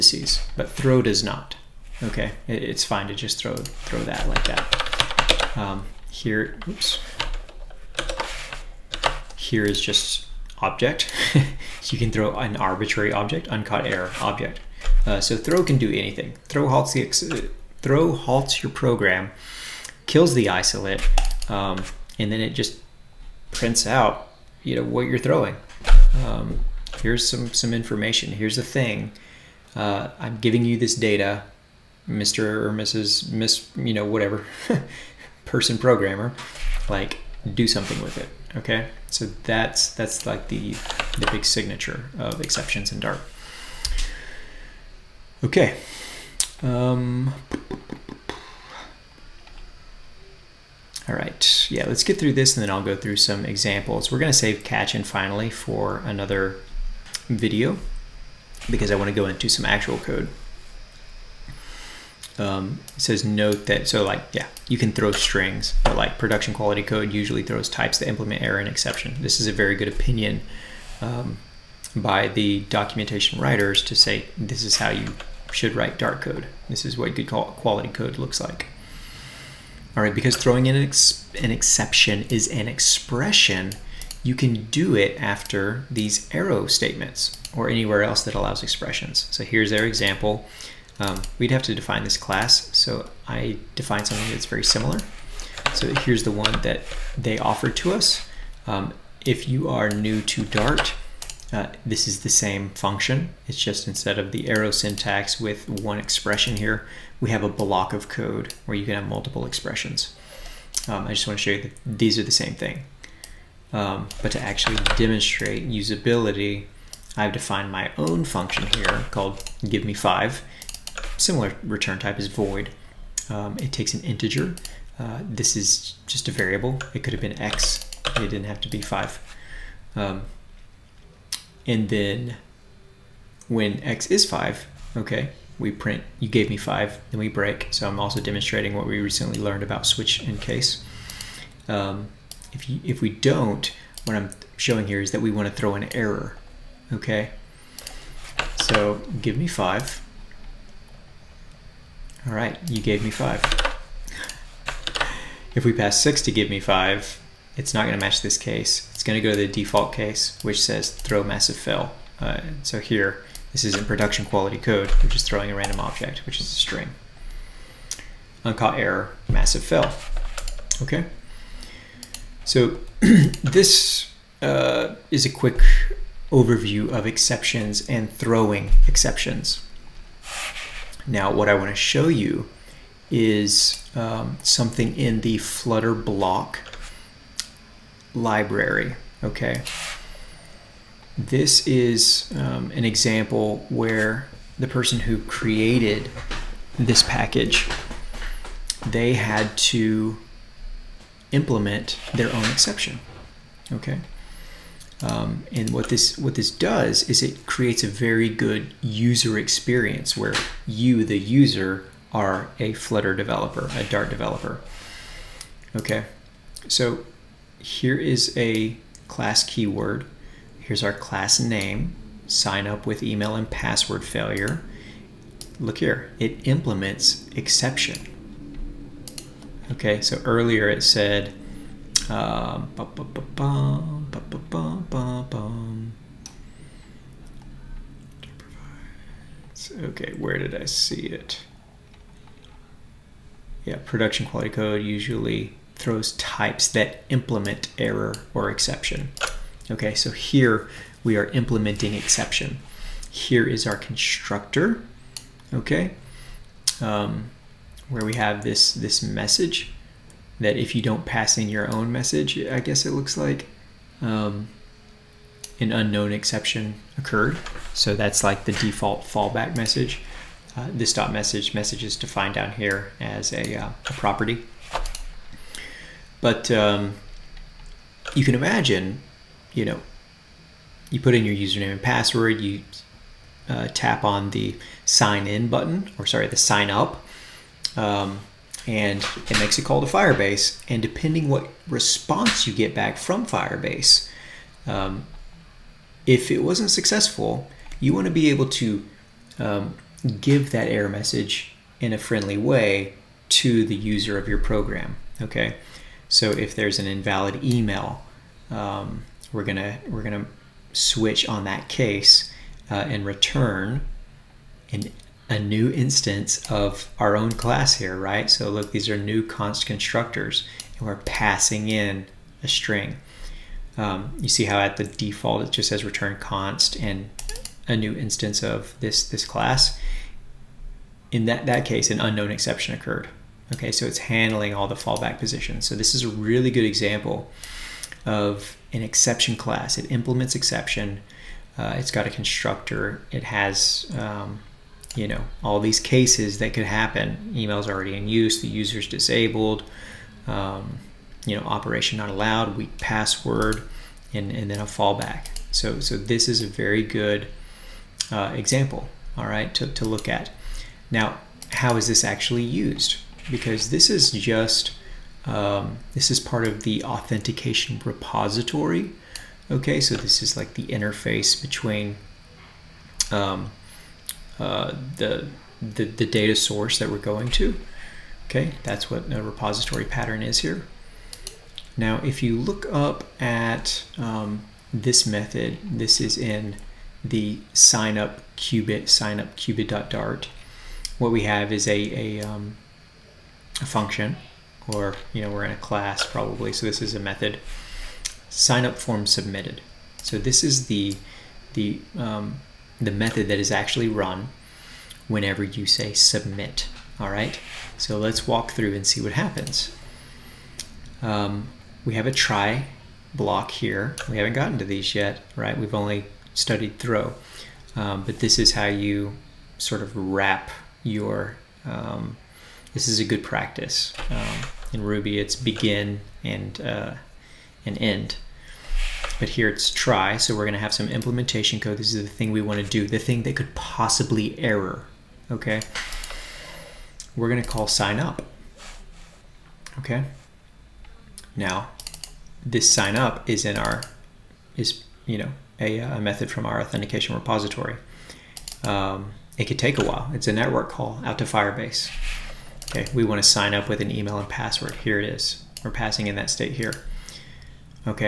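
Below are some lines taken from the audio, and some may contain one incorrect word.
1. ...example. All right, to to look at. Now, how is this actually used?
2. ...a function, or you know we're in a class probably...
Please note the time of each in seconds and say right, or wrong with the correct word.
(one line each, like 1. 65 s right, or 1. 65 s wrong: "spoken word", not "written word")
1. 358 s right
2. 393 s right.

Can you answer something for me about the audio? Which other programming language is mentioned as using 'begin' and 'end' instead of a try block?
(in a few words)
Ruby.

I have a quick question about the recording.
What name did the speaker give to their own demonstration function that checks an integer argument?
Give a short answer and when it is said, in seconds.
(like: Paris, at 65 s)
give me five, at 119 s.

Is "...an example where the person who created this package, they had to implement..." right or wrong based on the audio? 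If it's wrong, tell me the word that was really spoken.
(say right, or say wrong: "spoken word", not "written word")
right.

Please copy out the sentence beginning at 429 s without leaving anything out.
But here it's try, so we're going to have some implementation code.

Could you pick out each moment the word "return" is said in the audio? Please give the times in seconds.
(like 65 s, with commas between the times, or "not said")
121 s, 313 s, 325 s.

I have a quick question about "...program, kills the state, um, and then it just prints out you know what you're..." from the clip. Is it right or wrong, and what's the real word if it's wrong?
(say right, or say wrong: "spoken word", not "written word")
wrong: "isolate", not "state".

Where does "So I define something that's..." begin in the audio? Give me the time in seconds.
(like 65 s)
92 s.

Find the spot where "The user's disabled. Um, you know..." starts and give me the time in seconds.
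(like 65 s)
348 s.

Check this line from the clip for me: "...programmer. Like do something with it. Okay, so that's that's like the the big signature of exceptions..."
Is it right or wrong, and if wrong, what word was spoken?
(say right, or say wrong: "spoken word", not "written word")
right.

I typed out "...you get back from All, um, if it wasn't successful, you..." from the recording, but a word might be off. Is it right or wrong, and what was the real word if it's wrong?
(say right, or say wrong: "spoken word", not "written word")
wrong: "Firebase", not "All".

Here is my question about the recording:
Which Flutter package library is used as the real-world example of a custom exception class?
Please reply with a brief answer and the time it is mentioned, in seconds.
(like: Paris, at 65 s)
block library, at 185 s.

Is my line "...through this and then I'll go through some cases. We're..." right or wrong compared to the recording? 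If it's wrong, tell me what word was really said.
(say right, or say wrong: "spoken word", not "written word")
wrong: "examples", not "cases".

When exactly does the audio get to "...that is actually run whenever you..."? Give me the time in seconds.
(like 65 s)
403 s.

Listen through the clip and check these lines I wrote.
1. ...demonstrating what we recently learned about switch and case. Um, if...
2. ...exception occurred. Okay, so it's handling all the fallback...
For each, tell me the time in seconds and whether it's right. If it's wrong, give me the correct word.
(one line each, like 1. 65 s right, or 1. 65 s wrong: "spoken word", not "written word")
1. 138 s right
2. 332 s right.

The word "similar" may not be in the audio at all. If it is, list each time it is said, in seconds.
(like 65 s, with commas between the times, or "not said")
94 s, 121 s.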